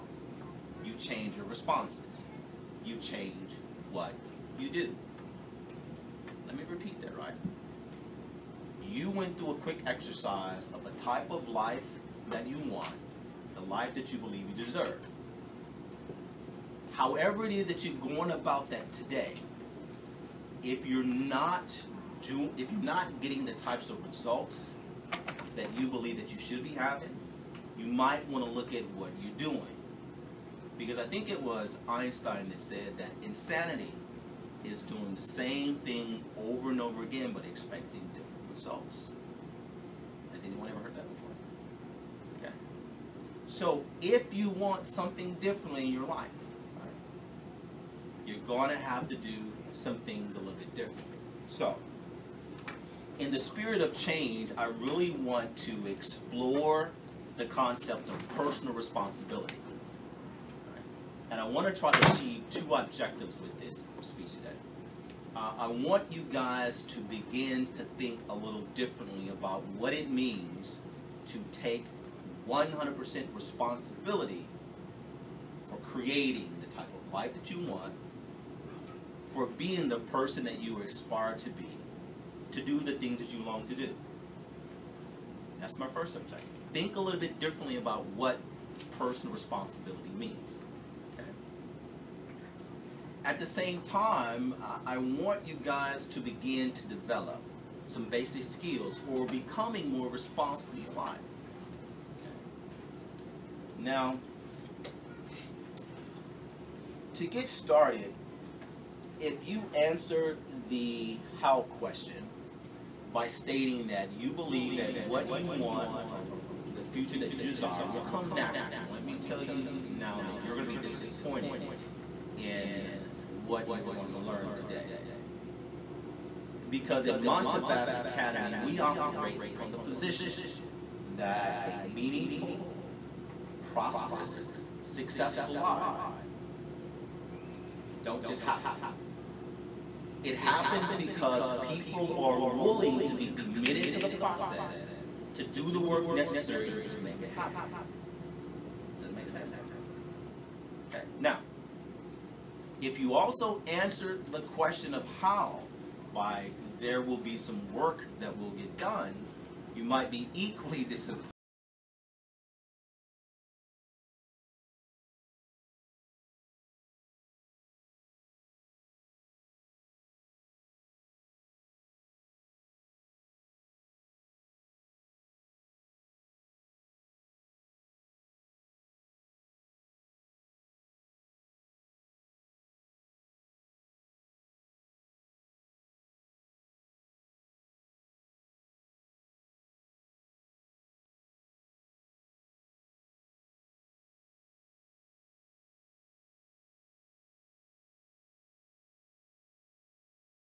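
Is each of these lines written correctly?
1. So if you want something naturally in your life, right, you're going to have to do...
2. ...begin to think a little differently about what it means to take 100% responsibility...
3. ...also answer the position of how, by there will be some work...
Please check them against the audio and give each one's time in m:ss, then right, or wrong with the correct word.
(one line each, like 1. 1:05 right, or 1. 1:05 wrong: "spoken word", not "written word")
1. 0:43 wrong: "differently", not "naturally"
2. 1:07 right
3. 2:33 wrong: "question", not "position".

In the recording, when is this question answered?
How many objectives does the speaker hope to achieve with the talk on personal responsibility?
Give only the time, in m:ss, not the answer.
1:02.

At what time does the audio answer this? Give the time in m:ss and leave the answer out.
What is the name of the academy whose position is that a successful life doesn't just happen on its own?
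2:07.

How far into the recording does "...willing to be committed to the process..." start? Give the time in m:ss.
2:22.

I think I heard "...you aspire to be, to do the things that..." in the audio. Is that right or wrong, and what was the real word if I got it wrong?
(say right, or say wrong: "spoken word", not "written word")
right.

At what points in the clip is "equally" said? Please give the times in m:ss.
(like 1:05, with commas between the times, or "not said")
2:40.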